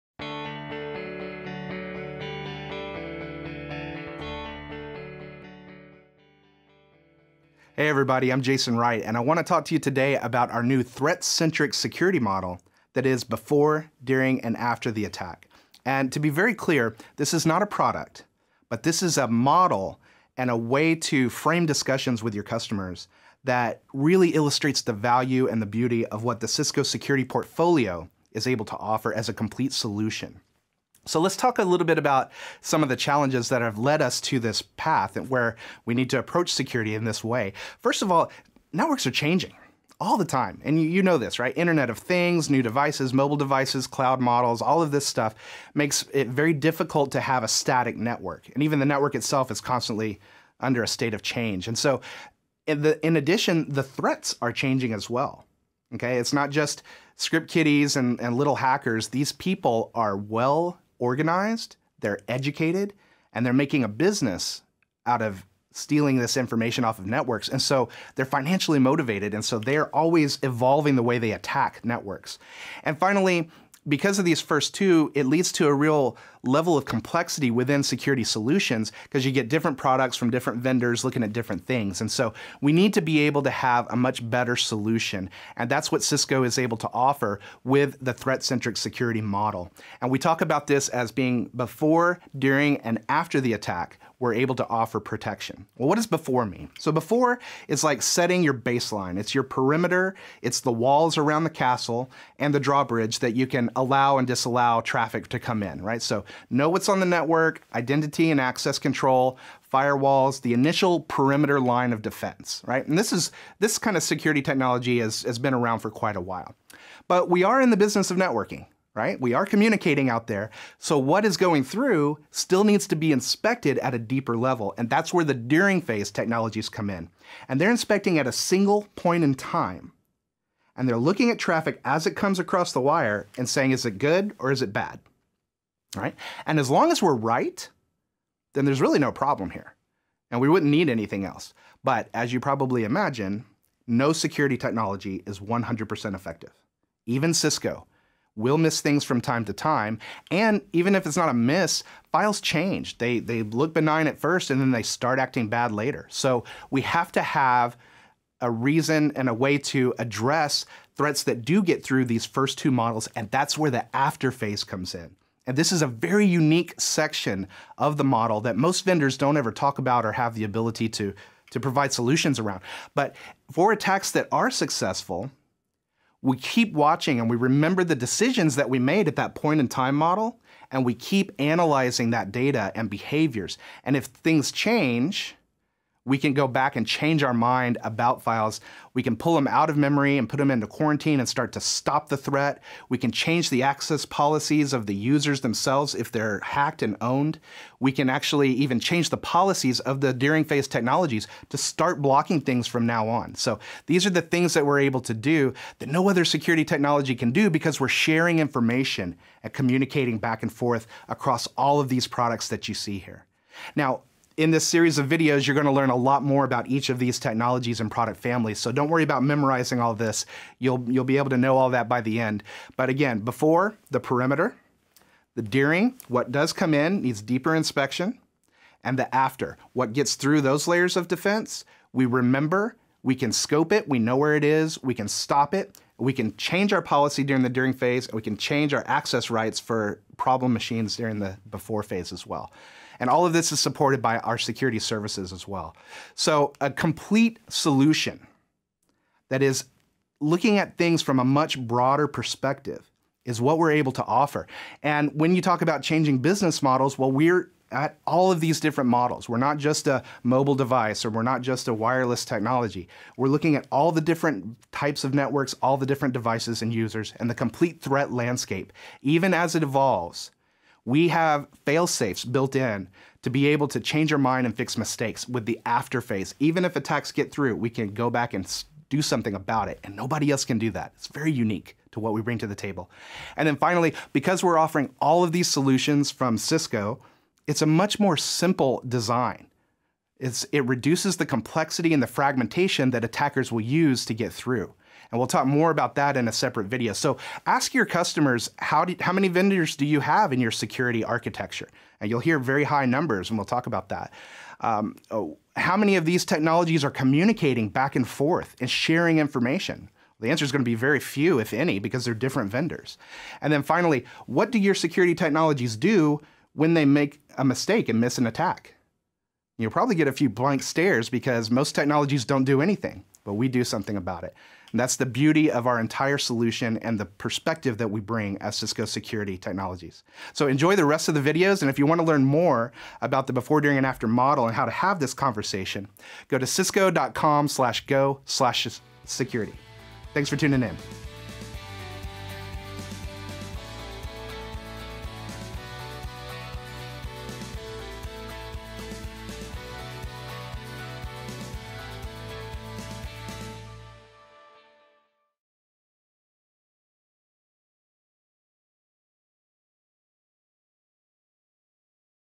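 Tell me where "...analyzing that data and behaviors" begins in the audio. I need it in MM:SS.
03:01.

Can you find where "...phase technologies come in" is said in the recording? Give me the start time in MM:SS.
02:05.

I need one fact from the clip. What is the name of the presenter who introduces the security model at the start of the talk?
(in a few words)
Jason Wright.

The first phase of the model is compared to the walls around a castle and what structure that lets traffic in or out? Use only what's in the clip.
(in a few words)
The drawbridge.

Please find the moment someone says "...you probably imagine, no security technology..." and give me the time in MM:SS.
02:22.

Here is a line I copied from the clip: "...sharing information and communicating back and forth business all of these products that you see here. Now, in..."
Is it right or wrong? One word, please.
wrong.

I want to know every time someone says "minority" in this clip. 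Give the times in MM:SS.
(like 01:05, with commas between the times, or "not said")
not said.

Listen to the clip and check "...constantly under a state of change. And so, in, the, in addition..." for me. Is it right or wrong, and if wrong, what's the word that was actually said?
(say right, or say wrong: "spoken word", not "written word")
right.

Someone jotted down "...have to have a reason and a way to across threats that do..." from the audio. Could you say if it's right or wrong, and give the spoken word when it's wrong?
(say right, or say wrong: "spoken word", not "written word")
wrong: "address", not "across".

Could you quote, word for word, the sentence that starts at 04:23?
We're looking at all the different types of networks, all the different devices and users, and the complete threat landscape.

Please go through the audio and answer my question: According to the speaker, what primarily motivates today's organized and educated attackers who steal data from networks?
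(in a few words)
Financially motivated.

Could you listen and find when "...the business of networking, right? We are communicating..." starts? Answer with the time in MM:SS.
01:57.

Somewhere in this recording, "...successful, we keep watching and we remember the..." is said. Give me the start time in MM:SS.
02:54.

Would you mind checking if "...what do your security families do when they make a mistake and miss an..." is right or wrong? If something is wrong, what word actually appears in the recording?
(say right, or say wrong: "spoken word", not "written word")
wrong: "technologies", not "families".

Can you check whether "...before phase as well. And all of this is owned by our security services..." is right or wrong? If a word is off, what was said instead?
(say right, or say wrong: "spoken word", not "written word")
wrong: "supported", not "owned".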